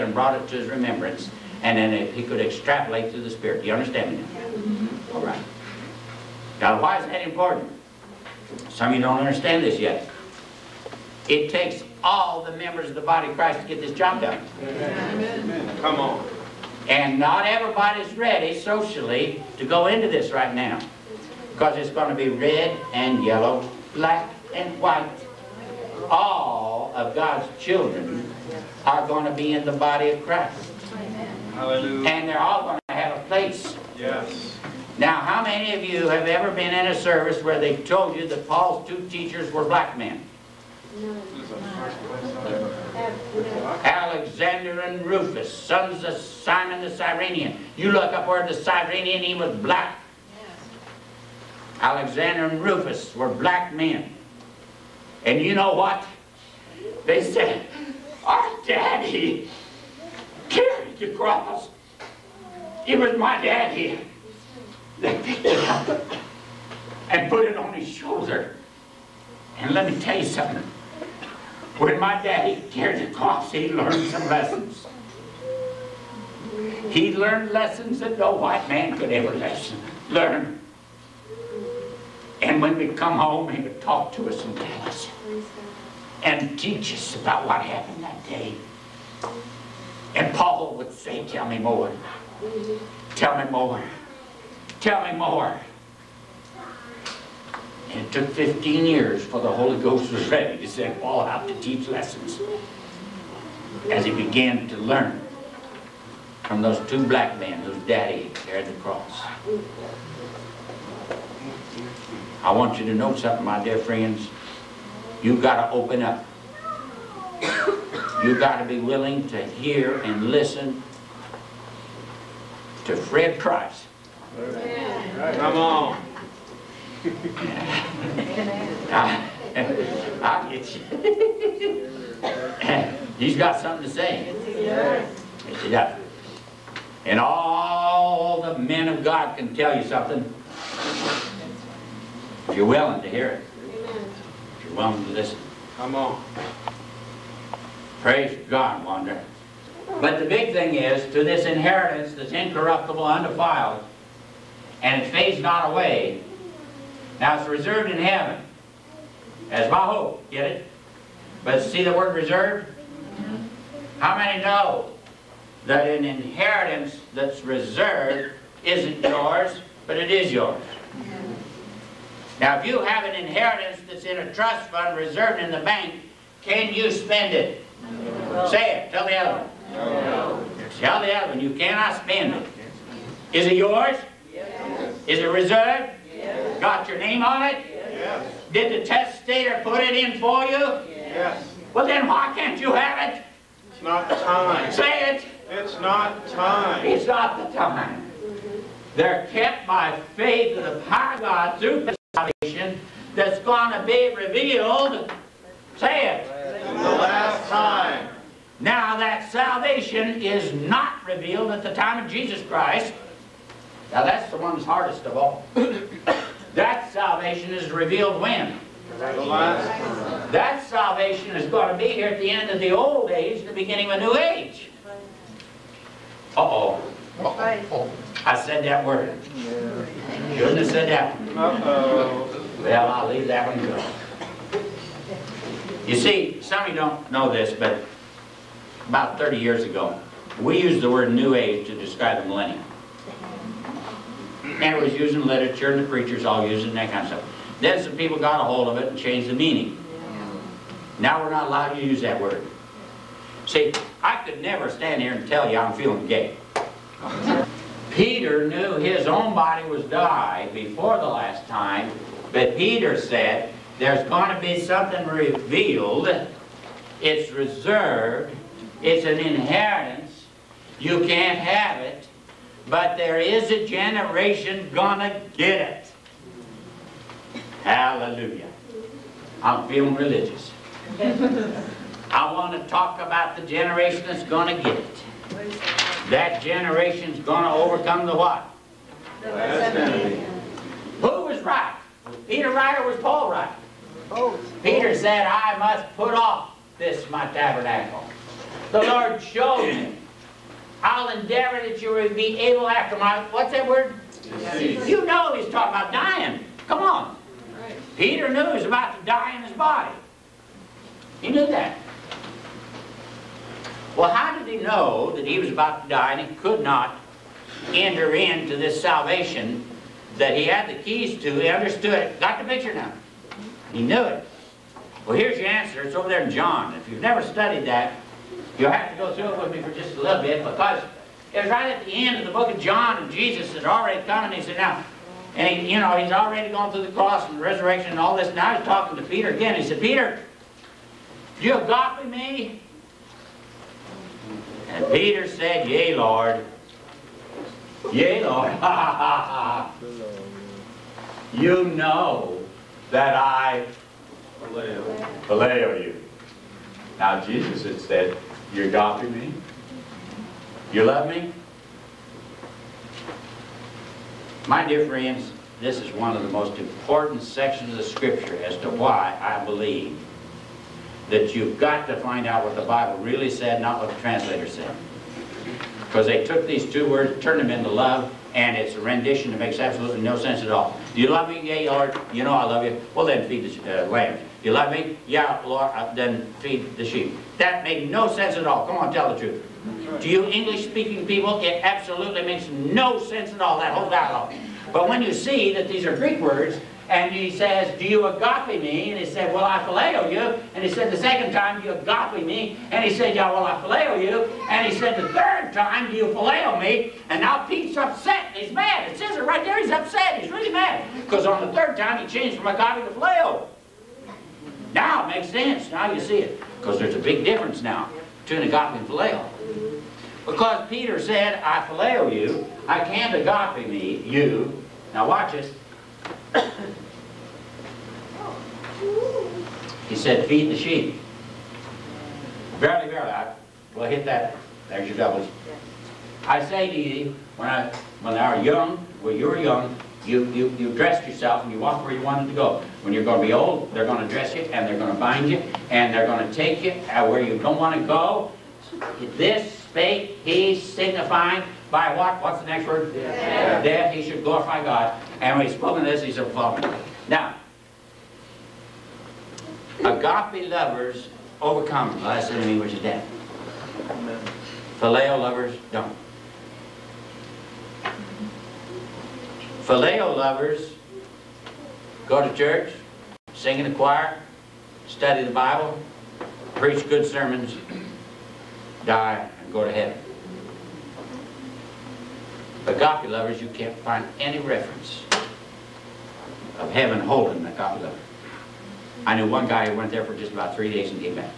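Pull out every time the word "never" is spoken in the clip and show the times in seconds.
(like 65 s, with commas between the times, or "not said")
254 s, 327 s.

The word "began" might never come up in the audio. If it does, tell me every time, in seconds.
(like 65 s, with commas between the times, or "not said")
104 s.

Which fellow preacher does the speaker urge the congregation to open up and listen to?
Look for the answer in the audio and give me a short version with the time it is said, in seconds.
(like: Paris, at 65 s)
Fred Price, at 122 s.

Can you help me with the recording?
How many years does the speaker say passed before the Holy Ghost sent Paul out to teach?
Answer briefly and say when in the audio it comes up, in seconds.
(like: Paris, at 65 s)
15, at 98 s.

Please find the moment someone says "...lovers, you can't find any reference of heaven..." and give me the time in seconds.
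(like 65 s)
483 s.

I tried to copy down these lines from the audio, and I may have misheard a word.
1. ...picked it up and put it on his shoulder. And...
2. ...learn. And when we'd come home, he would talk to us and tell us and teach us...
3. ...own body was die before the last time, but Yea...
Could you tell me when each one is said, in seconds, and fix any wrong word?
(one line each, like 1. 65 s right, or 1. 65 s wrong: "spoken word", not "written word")
1. 65 s right
2. 80 s right
3. 259 s wrong: "Peter", not "Yea".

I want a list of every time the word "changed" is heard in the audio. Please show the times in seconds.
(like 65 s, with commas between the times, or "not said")
248 s, 412 s.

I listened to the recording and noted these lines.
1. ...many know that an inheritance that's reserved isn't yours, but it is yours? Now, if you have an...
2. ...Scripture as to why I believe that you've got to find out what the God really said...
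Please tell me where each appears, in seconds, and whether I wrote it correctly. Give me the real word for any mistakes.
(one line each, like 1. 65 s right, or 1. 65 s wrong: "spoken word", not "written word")
1. 164 s right
2. 367 s wrong: "Bible", not "God".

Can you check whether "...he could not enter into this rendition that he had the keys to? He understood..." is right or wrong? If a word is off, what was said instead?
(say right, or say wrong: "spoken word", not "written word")
wrong: "salvation", not "rendition".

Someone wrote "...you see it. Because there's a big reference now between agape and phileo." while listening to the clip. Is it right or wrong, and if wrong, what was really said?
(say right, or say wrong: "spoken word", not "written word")
wrong: "difference", not "reference".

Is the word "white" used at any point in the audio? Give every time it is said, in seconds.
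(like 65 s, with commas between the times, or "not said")
24 s, 78 s.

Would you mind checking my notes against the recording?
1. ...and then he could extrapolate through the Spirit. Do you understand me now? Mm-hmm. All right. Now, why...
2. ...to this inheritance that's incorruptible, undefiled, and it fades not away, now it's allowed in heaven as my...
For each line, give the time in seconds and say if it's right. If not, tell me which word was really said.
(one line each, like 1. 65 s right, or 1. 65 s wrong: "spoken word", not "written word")
1. 1 s right
2. 151 s wrong: "reserved", not "allowed".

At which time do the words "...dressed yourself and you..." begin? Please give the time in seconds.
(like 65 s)
440 s.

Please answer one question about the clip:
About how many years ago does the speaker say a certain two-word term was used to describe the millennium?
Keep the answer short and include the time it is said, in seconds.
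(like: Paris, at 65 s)
30, at 239 s.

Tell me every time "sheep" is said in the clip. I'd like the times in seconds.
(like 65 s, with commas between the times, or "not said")
386 s, 430 s.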